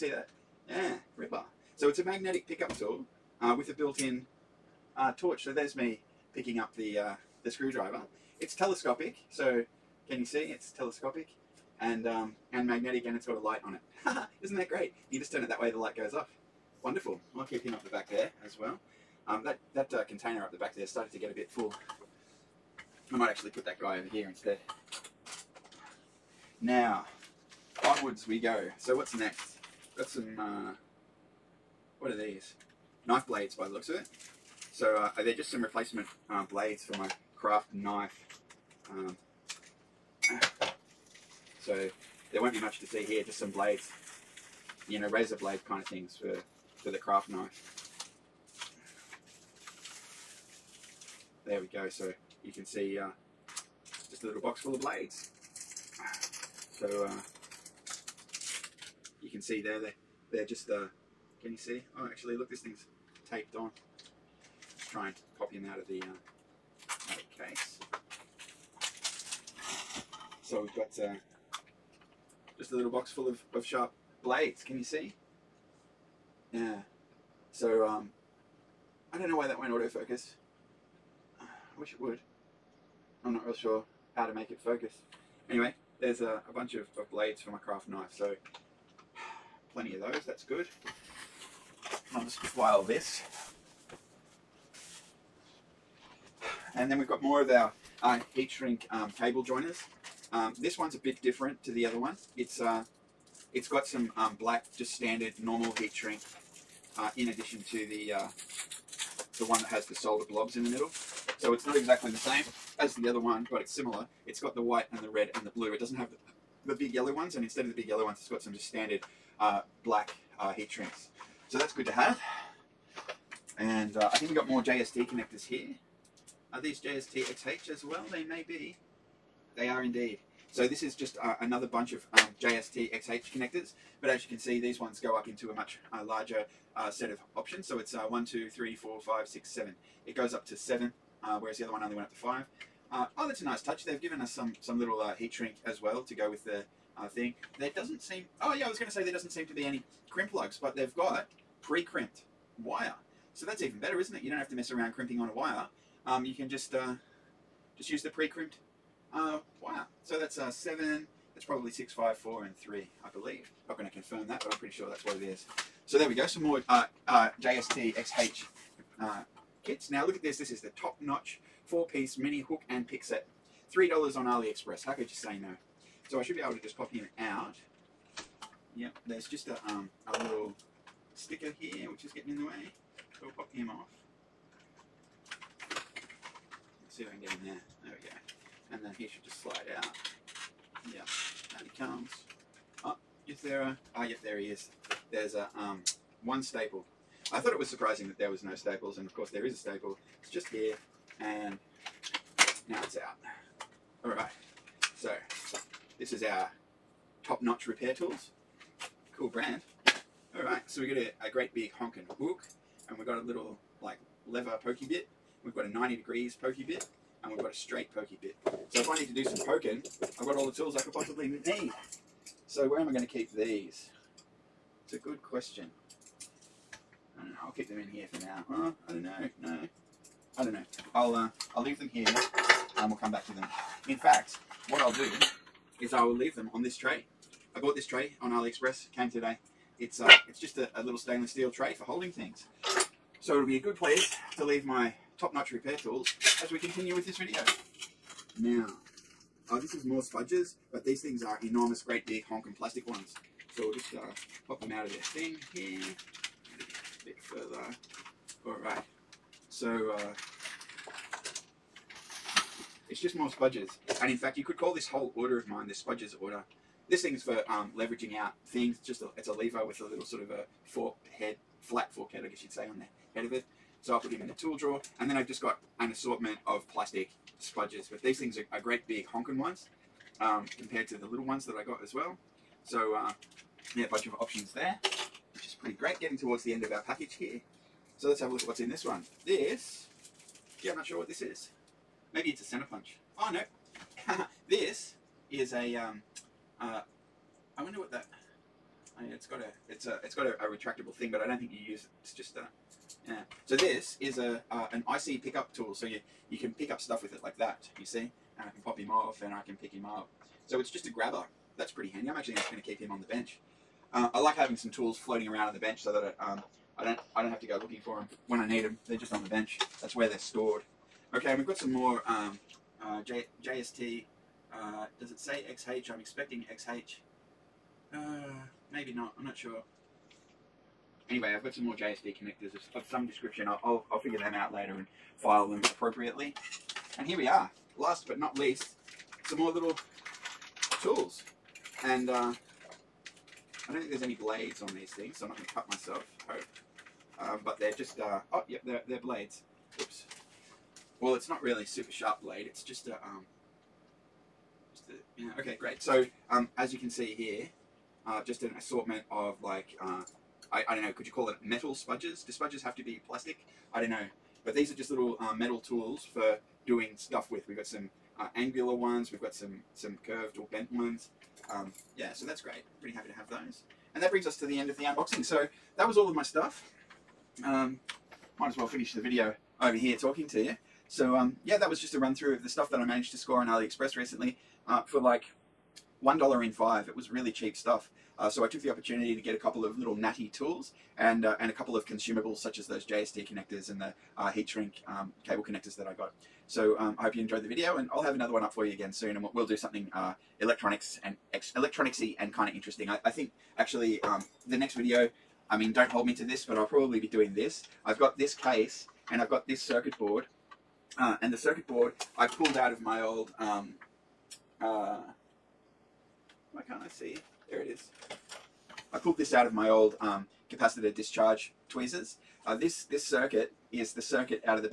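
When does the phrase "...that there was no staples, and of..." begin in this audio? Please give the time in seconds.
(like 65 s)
198 s.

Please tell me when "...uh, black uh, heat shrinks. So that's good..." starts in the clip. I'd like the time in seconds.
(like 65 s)
119 s.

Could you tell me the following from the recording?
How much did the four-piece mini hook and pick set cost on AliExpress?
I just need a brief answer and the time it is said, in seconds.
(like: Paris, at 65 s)
3 dollars, at 173 s.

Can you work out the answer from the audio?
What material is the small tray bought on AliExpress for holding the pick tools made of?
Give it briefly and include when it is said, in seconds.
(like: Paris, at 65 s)
stainless steel, at 240 s.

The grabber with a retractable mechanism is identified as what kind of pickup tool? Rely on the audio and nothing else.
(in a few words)
IC pickup tool.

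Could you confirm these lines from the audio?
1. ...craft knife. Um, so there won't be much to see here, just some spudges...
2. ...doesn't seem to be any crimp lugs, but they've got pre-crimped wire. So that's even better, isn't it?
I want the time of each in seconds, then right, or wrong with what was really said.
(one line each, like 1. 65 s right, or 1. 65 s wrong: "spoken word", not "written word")
1. 37 s wrong: "blades", not "spudges"
2. 149 s right.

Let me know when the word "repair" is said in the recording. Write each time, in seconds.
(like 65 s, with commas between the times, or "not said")
207 s, 245 s.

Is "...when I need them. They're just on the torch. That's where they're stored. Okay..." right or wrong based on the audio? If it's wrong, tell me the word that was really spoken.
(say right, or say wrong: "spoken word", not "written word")
wrong: "bench", not "torch".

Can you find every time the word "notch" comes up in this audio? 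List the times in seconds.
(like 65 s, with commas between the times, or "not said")
170 s, 207 s, 245 s.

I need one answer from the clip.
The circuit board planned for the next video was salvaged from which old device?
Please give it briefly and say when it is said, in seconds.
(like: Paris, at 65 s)
capacitor discharge tweezers, at 420 s.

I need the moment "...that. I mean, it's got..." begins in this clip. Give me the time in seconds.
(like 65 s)
297 s.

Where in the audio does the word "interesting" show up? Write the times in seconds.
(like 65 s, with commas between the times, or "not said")
402 s.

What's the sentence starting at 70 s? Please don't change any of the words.
So we've got uh, just a little box full of, of sharp blades.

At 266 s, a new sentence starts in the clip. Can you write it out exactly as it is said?
This thing's for um, leveraging out things.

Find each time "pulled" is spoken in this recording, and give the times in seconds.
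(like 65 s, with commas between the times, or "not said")
412 s, 418 s.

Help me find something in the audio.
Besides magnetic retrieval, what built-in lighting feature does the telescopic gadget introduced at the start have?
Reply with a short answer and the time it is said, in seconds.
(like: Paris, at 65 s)
torch, at 5 s.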